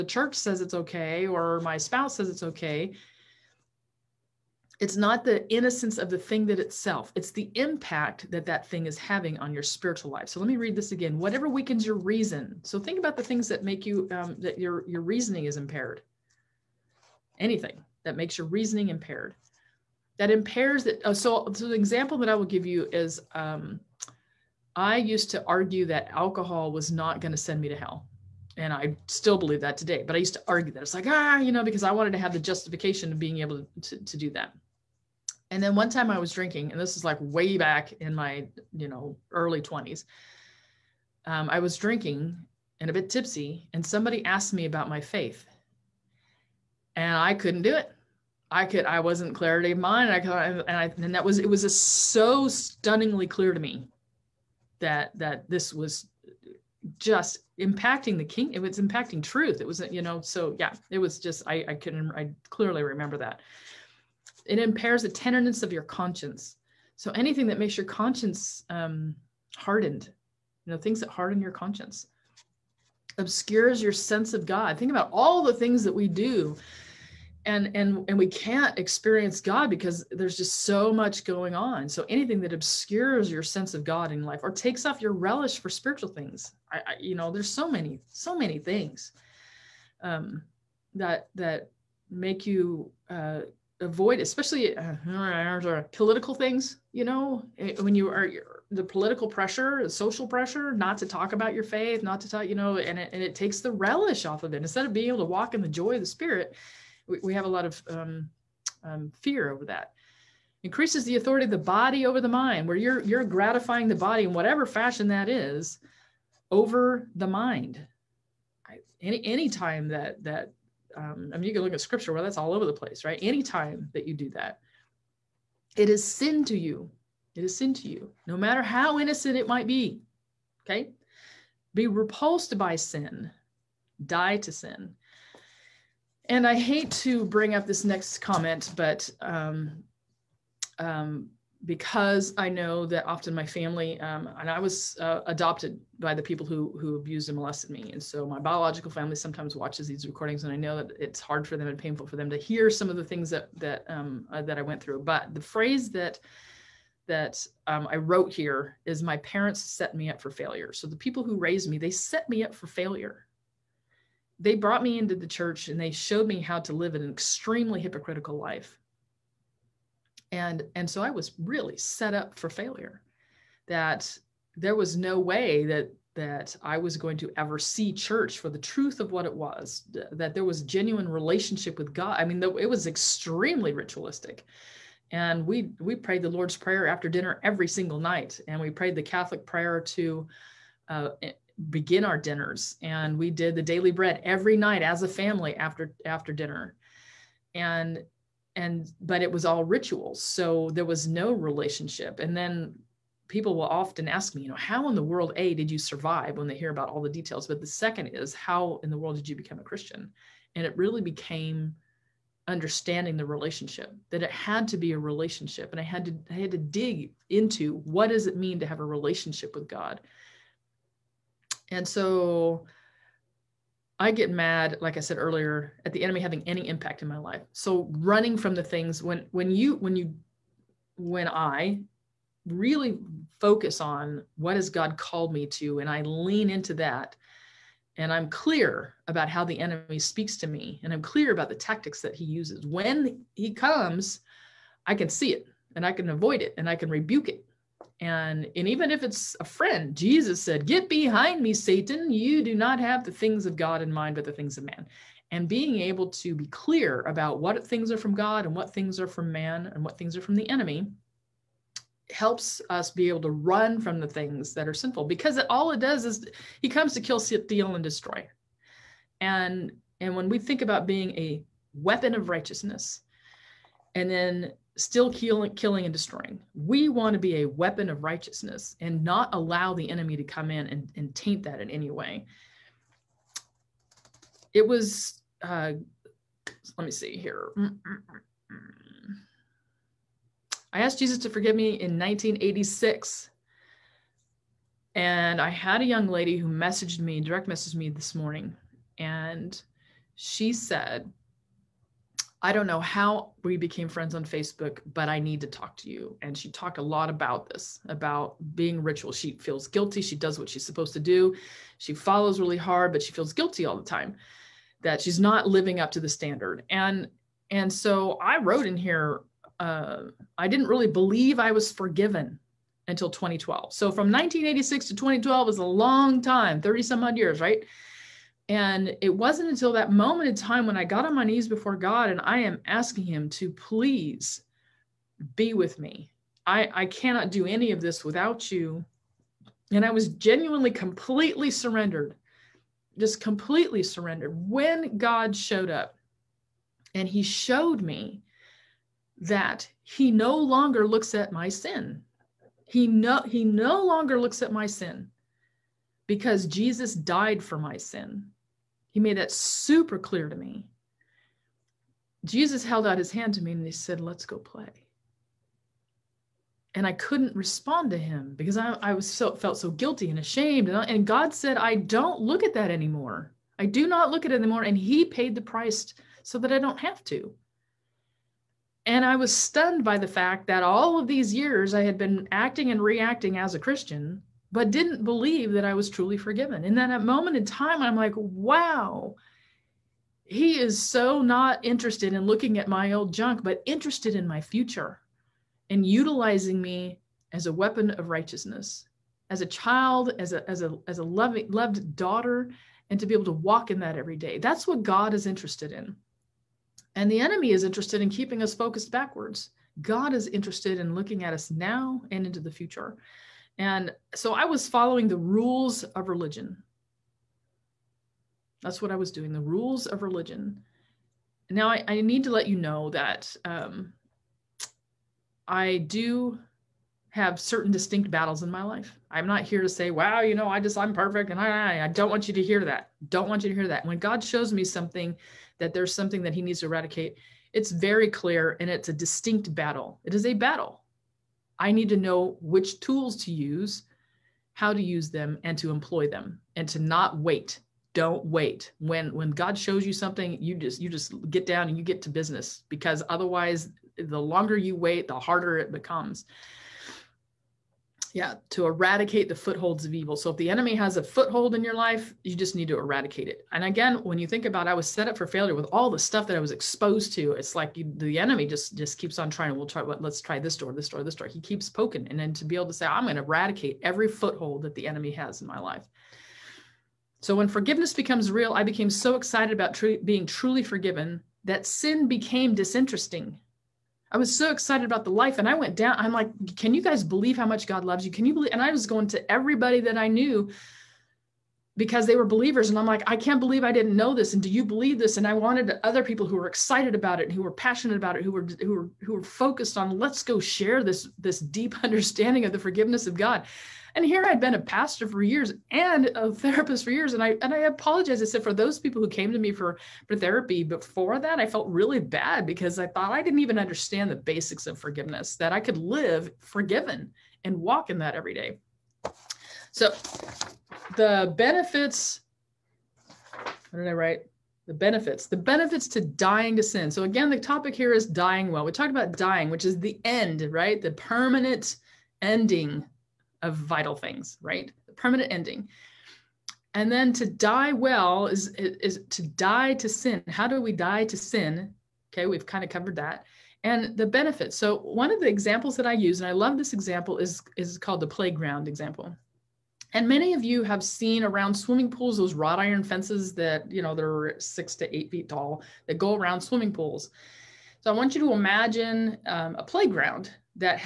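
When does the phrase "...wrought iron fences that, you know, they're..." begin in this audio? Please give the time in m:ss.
9:12.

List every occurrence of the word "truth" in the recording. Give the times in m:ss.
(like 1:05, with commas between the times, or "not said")
0:59, 2:58.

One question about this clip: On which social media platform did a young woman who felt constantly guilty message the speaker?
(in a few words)
Facebook.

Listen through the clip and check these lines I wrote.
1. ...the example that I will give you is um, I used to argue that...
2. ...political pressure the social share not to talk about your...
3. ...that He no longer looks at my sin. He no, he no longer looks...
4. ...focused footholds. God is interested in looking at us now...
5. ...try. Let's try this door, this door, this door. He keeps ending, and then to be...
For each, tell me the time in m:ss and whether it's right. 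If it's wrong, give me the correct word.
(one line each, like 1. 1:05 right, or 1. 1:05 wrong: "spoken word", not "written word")
1. 0:21 right
2. 1:38 wrong: "pressure", not "share"
3. 5:49 right
4. 6:48 wrong: "backwards", not "footholds"
5. 7:49 wrong: "poking", not "ending".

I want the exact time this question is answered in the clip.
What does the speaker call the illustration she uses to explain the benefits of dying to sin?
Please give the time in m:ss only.
9:08.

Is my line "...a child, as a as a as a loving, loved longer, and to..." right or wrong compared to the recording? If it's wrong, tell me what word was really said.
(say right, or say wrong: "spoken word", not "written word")
wrong: "daughter", not "longer".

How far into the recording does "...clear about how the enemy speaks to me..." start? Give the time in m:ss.
3:58.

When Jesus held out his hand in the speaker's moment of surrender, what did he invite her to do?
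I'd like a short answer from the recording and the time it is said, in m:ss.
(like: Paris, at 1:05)
Let's go play, at 6:03.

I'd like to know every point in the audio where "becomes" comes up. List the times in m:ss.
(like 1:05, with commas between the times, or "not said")
3:29, 7:35, 7:57.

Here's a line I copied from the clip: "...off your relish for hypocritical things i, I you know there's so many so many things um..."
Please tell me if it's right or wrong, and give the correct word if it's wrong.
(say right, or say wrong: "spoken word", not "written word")
wrong: "spiritual", not "hypocritical".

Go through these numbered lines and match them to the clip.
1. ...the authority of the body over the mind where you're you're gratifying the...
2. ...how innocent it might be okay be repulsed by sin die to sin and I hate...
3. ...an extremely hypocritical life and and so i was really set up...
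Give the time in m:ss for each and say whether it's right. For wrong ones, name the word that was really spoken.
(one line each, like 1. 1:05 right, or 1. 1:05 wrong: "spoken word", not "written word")
1. 1:51 right
2. 2:08 right
3. 2:46 right.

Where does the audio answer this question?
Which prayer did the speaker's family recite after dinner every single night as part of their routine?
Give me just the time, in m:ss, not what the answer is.
3:06.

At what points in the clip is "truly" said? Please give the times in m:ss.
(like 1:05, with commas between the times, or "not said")
6:25, 8:00.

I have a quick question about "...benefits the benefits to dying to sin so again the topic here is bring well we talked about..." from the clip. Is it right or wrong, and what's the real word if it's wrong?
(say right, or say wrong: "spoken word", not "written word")
wrong: "dying", not "bring".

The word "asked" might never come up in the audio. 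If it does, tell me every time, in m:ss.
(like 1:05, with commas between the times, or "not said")
0:44, 4:50.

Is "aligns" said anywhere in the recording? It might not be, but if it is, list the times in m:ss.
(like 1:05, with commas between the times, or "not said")
not said.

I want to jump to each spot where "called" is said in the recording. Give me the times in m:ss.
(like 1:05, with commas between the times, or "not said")
3:54, 9:07.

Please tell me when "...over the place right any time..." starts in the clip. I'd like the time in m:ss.
2:02.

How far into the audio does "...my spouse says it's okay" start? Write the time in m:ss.
0:01.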